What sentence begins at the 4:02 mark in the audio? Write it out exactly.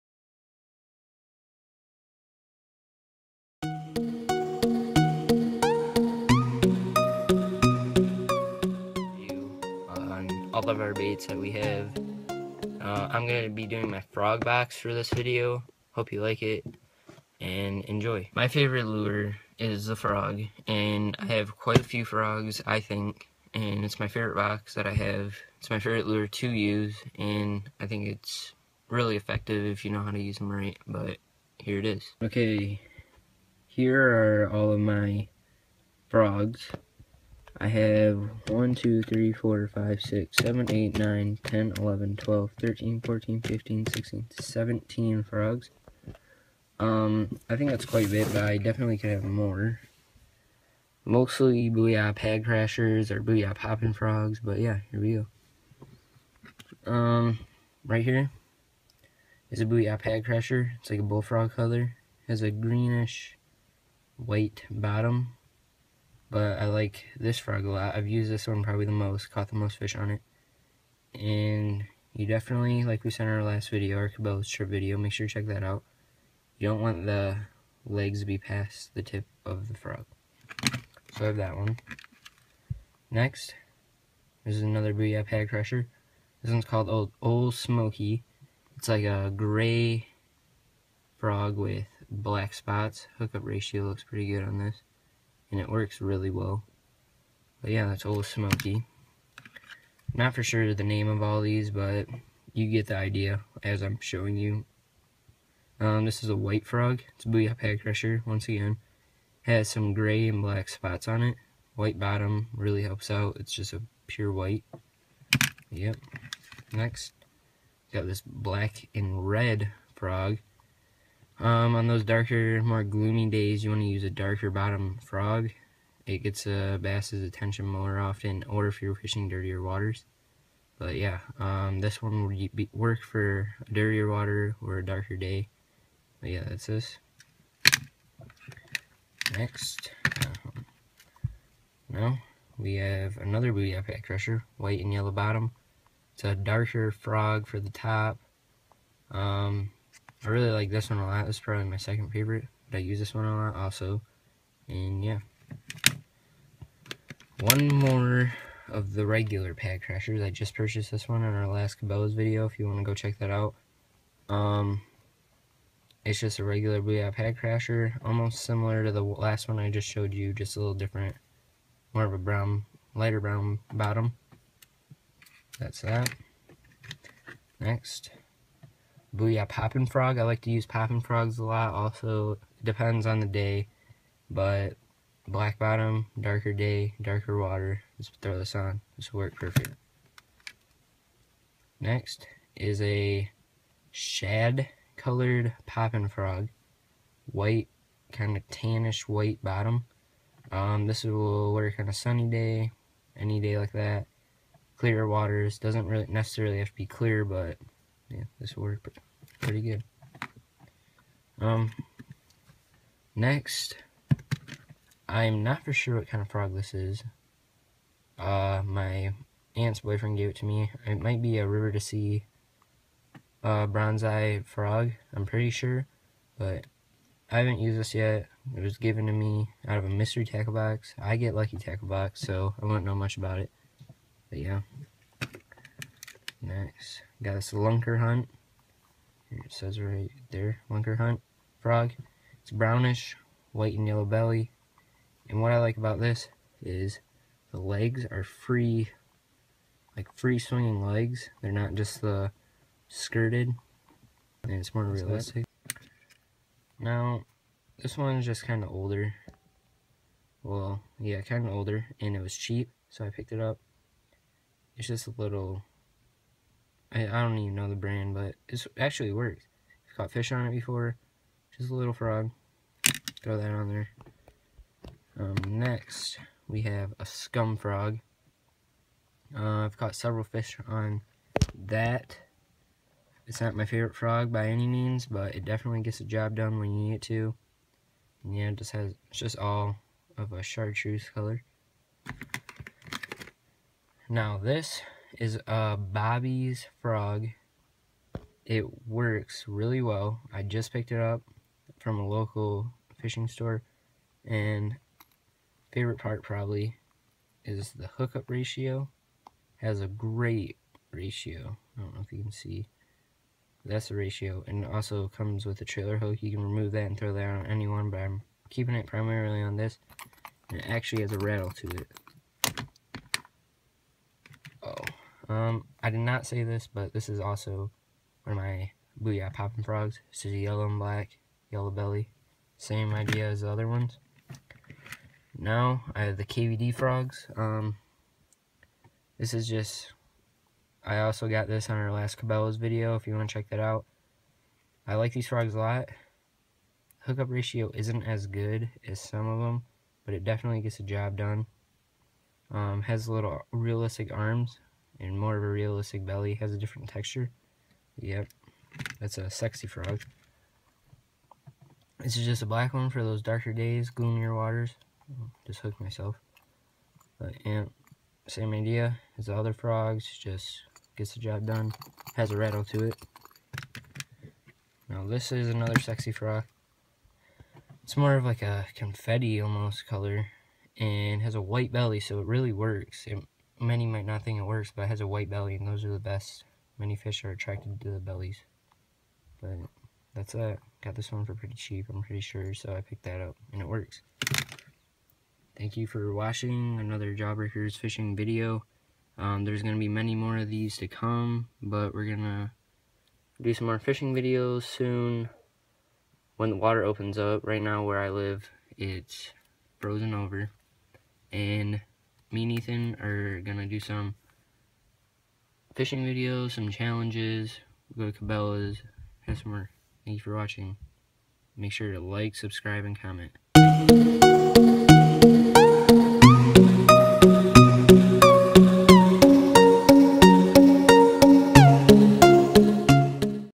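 It's brownish, white and yellow belly.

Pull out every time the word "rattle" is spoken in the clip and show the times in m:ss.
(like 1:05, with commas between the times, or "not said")
5:21, 6:12.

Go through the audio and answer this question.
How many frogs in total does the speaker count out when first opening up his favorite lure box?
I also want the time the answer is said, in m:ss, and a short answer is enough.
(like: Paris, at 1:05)
17, at 0:44.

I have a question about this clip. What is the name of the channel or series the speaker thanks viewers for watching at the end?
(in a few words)
Jawbreakers.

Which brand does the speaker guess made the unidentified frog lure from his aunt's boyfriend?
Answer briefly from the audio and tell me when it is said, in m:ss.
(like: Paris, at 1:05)
River2Sea, at 3:41.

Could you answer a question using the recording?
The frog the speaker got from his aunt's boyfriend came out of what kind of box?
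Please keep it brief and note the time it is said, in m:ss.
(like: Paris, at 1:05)
mystery tackle box, at 3:49.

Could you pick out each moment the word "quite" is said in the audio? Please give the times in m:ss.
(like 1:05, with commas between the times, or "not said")
0:21, 0:47.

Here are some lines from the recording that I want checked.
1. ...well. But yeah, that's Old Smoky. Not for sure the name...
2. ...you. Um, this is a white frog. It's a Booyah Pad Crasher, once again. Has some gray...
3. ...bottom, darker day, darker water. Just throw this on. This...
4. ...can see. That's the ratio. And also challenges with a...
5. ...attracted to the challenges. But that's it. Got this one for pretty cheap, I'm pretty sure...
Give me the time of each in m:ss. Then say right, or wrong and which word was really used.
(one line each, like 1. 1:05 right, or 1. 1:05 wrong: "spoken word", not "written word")
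1. 1:36 right
2. 1:44 right
3. 3:05 right
4. 5:12 wrong: "comes", not "challenges"
5. 6:27 wrong: "bellies", not "challenges".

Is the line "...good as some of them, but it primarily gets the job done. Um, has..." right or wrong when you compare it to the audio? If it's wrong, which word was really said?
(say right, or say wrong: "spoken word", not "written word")
wrong: "definitely", not "primarily".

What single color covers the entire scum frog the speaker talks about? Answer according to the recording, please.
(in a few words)
chartreuse.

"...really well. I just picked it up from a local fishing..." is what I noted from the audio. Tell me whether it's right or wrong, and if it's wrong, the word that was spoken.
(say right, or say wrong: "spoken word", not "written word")
right.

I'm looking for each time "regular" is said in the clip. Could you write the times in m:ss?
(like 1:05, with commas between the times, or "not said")
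2:39, 2:46.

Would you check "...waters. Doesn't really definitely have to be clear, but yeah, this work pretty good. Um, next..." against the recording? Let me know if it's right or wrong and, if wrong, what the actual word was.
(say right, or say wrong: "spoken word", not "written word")
wrong: "necessarily", not "definitely".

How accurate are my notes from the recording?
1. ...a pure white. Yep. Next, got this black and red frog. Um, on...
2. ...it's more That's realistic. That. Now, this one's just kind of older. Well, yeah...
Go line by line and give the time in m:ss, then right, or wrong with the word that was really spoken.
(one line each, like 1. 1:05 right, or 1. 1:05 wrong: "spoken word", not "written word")
1. 1:53 right
2. 4:14 right.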